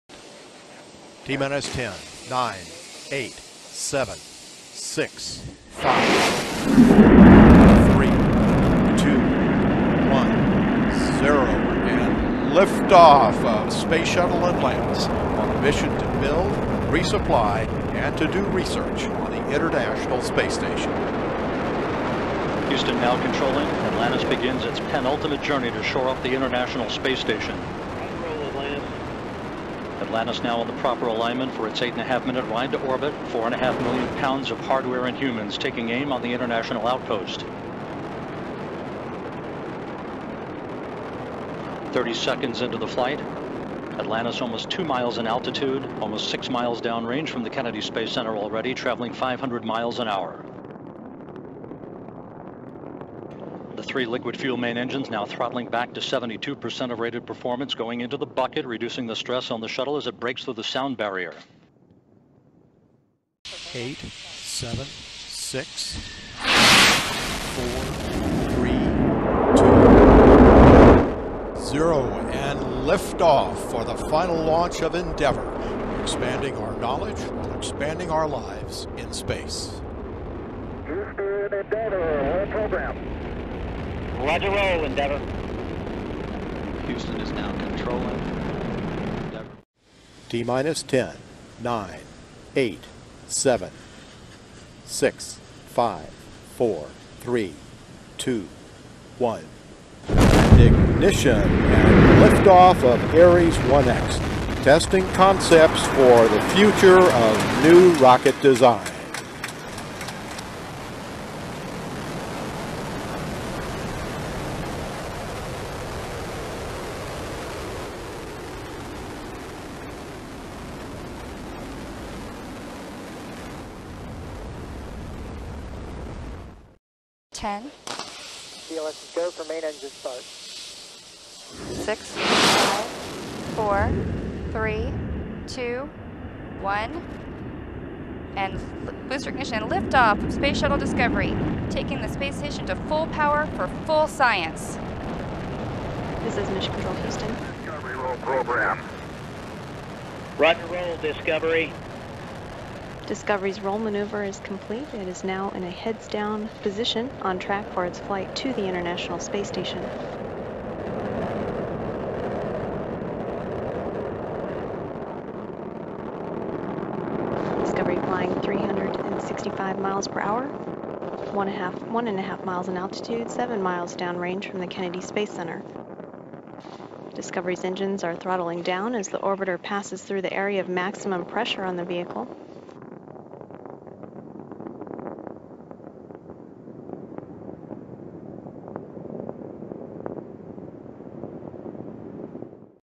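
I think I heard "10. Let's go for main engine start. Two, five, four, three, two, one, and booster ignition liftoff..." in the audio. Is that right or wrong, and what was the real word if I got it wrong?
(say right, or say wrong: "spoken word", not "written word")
wrong: "Six", not "Two".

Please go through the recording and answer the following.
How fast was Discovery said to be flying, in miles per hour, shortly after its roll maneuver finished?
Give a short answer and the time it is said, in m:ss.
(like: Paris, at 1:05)
365 mph, at 2:48.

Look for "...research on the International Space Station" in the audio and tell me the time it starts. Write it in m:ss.
0:18.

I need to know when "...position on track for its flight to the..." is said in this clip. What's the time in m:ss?
2:36.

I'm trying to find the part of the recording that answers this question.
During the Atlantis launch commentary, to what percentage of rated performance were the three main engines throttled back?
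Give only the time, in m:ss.
0:55.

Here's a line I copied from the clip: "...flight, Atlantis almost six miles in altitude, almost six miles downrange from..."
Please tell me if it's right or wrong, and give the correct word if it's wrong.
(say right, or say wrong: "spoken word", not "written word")
wrong: "two", not "six".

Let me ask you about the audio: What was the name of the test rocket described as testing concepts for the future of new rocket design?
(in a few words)
Ares 1X.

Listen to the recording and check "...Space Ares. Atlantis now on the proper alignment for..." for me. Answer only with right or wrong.
wrong.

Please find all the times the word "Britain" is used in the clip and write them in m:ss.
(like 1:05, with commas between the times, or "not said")
not said.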